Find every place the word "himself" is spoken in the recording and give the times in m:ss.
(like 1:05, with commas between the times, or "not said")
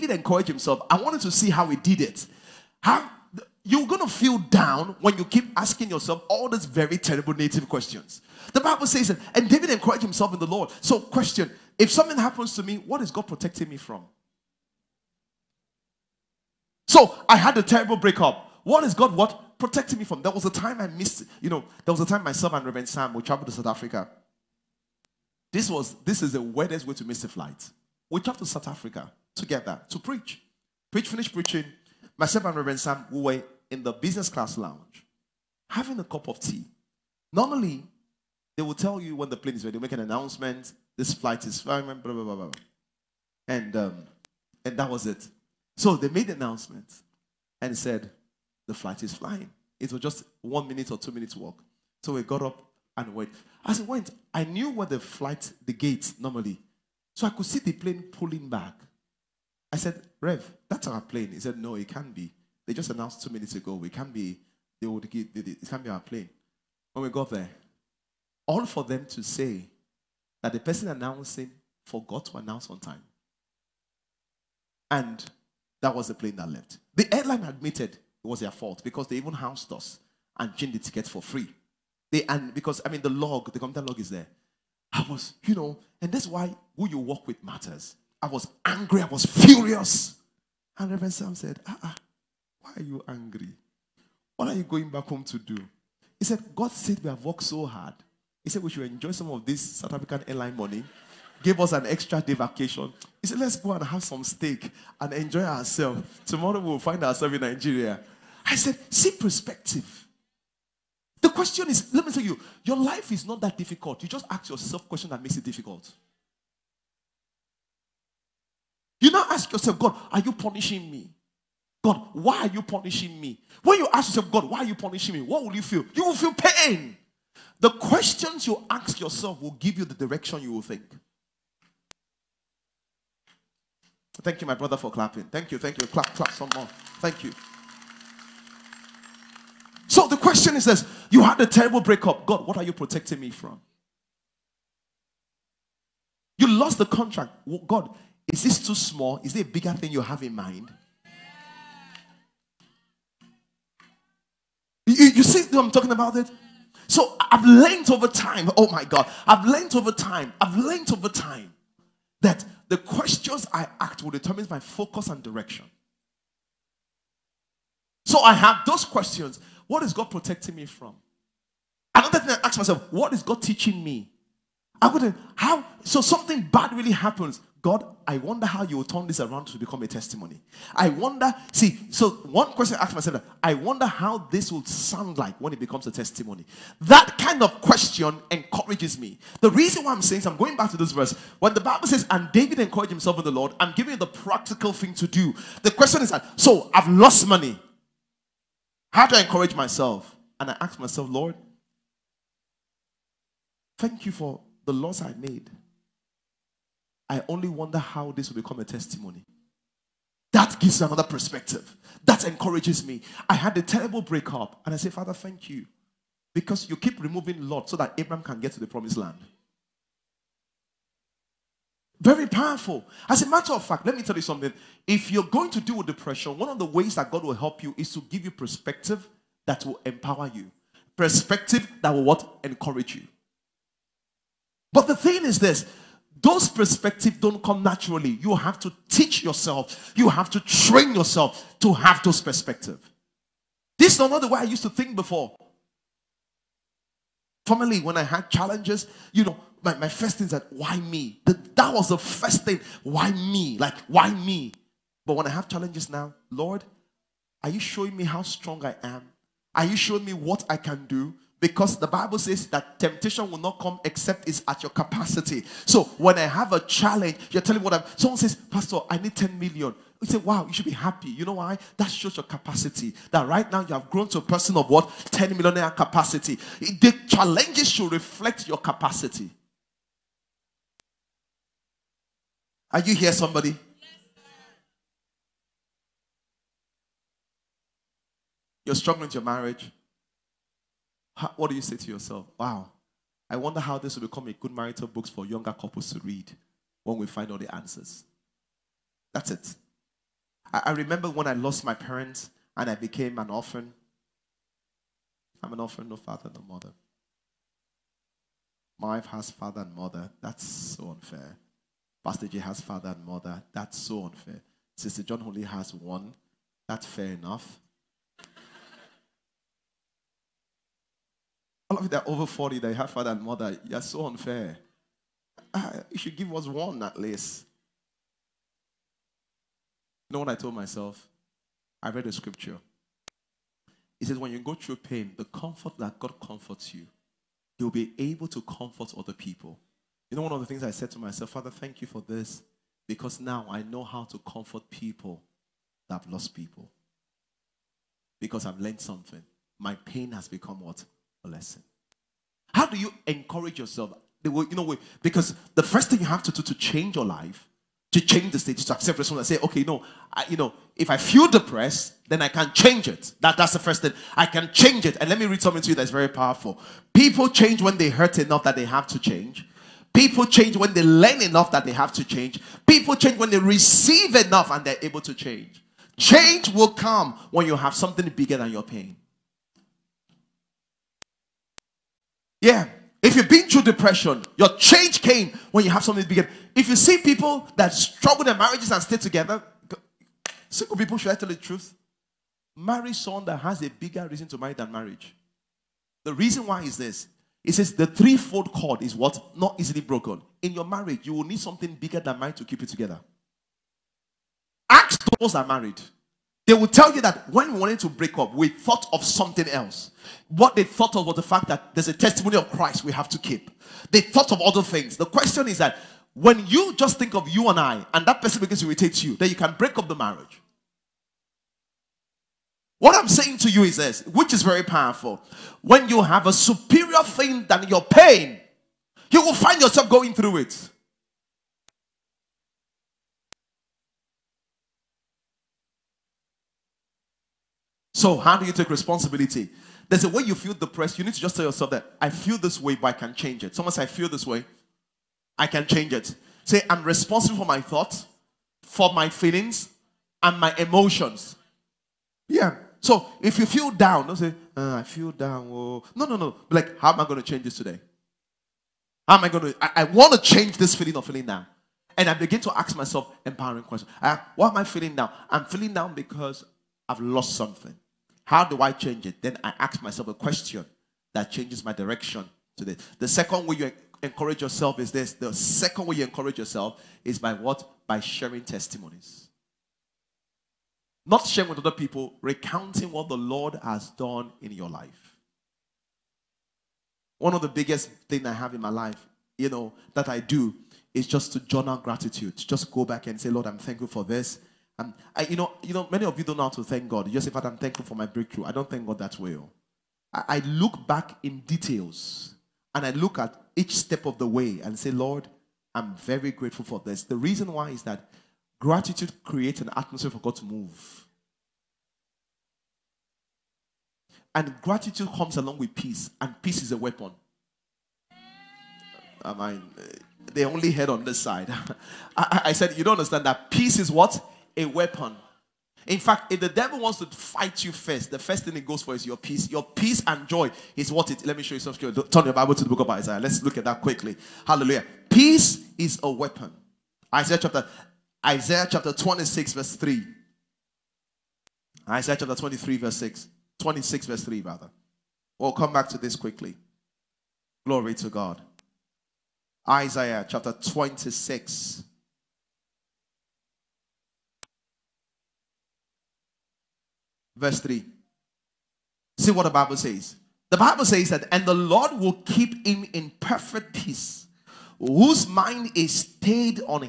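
0:00, 0:10, 3:12.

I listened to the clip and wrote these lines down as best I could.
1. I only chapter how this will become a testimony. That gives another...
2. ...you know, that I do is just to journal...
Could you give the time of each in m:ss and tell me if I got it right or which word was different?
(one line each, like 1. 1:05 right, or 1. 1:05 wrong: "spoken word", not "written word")
1. 3:27 wrong: "wonder", not "chapter"
2. 8:09 right.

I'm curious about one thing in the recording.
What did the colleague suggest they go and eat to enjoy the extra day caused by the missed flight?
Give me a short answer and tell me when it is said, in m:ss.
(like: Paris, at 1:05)
Steak, at 1:44.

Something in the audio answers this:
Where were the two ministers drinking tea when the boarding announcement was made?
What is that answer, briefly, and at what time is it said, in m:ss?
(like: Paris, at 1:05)
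Business class lounge, at 0:33.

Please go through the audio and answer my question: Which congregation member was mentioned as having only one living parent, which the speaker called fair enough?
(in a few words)
Sister John.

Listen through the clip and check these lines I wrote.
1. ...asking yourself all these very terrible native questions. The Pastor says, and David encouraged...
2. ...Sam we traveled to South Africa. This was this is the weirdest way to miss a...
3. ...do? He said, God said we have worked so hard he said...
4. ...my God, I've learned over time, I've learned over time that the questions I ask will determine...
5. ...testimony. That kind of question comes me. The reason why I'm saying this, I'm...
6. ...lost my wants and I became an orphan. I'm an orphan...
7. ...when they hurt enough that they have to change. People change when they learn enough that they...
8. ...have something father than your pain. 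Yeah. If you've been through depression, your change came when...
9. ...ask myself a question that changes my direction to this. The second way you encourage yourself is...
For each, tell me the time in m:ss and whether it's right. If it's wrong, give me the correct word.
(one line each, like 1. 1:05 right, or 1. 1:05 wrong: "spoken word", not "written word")
1. 0:05 wrong: "Bible", not "Pastor"
2. 0:22 right
3. 1:35 right
4. 2:38 right
5. 3:05 wrong: "encourages", not "comes"
6. 5:01 wrong: "parents", not "wants"
7. 6:07 right
8. 6:17 wrong: "bigger", not "father"
9. 7:49 right.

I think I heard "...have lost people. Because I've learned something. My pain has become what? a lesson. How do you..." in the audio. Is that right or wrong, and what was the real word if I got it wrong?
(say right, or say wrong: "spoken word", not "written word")
right.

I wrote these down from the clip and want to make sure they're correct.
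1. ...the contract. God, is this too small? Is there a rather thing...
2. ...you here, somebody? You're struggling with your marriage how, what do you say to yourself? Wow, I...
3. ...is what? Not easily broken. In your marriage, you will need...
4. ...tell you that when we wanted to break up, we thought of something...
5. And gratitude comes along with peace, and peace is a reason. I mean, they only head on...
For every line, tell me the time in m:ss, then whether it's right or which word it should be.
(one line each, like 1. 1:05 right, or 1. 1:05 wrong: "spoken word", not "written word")
1. 2:26 wrong: "bigger", not "rather"
2. 4:42 right
3. 6:38 right
4. 6:46 right
5. 8:34 wrong: "weapon", not "reason".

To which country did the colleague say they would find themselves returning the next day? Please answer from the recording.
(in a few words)
Nigeria.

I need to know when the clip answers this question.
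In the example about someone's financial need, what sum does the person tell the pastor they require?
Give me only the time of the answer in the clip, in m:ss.
4:29.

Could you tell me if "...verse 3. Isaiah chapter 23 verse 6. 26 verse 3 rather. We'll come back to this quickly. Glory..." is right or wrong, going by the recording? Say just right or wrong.
right.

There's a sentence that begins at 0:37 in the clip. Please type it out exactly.
Normally, they will tell you when the plane is ready, they make an announcement, this flight is flying, blah, blah, blah, blah.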